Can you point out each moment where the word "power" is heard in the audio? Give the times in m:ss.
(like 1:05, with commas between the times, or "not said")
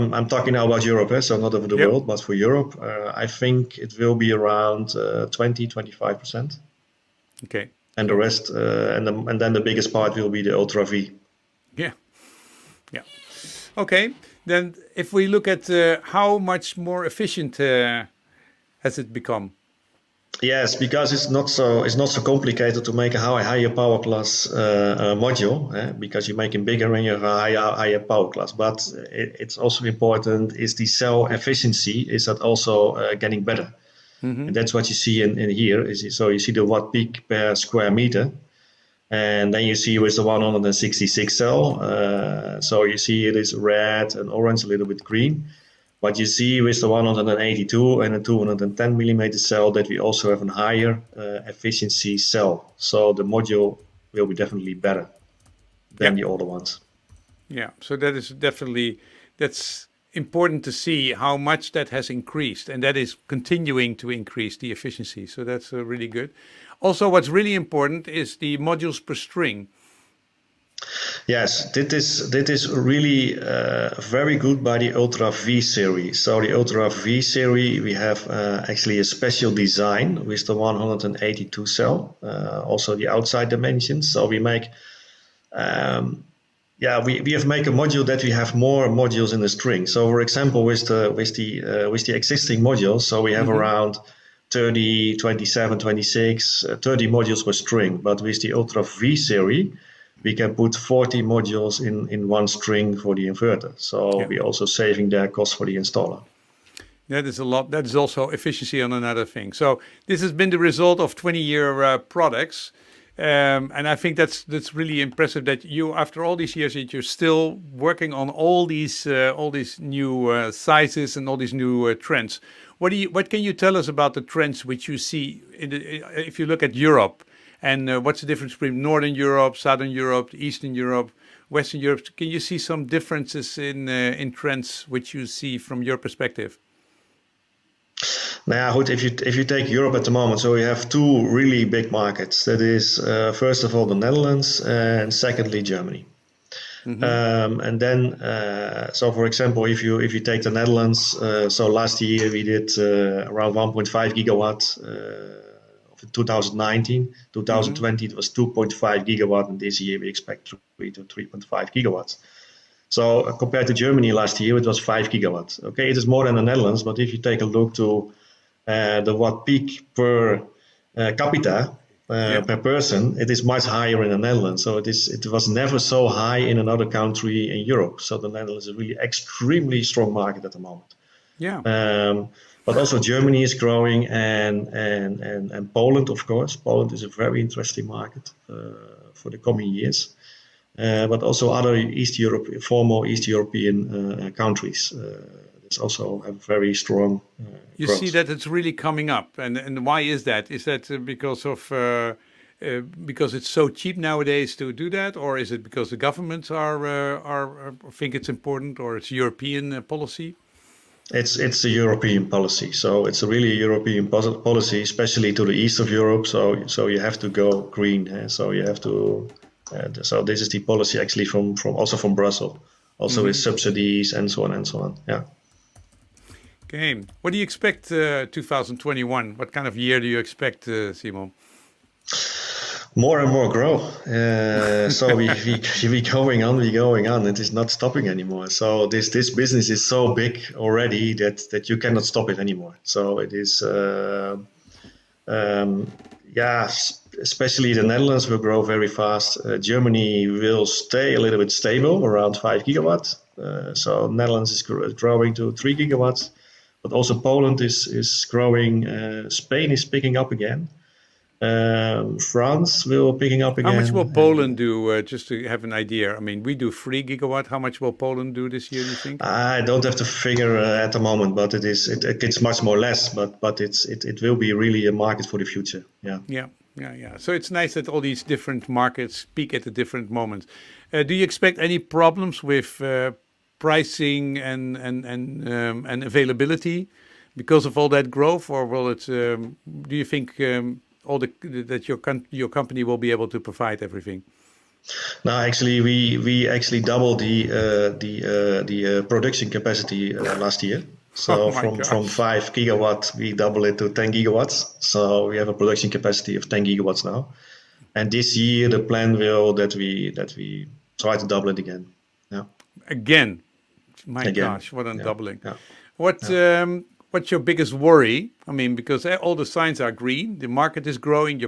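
0:23, 0:27.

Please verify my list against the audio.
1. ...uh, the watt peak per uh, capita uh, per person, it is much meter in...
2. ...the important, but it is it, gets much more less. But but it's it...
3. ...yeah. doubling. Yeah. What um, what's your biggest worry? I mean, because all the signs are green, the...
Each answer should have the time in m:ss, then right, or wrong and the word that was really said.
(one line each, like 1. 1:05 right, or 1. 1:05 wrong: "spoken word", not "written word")
1. 2:48 wrong: "higher", not "meter"
2. 4:30 wrong: "moment", not "important"
3. 5:14 right.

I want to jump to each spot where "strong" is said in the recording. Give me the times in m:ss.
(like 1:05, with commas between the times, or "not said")
2:59, 3:16.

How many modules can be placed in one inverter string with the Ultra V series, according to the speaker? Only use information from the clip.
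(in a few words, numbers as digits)
40.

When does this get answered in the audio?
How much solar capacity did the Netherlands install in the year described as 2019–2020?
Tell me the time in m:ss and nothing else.
2:38.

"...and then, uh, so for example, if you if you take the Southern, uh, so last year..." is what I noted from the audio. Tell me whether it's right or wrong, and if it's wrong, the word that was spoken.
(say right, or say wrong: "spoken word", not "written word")
wrong: "Netherlands", not "Southern".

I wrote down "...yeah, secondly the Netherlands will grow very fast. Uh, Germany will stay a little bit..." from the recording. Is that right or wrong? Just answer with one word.
wrong.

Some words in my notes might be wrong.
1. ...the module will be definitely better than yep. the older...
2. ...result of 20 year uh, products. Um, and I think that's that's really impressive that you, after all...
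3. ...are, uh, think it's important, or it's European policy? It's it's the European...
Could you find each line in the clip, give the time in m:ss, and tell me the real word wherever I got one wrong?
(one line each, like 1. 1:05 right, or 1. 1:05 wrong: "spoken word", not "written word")
1. 0:53 right
2. 1:50 right
3. 3:27 right.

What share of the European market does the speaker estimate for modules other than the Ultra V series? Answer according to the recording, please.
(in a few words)
20-25 percent.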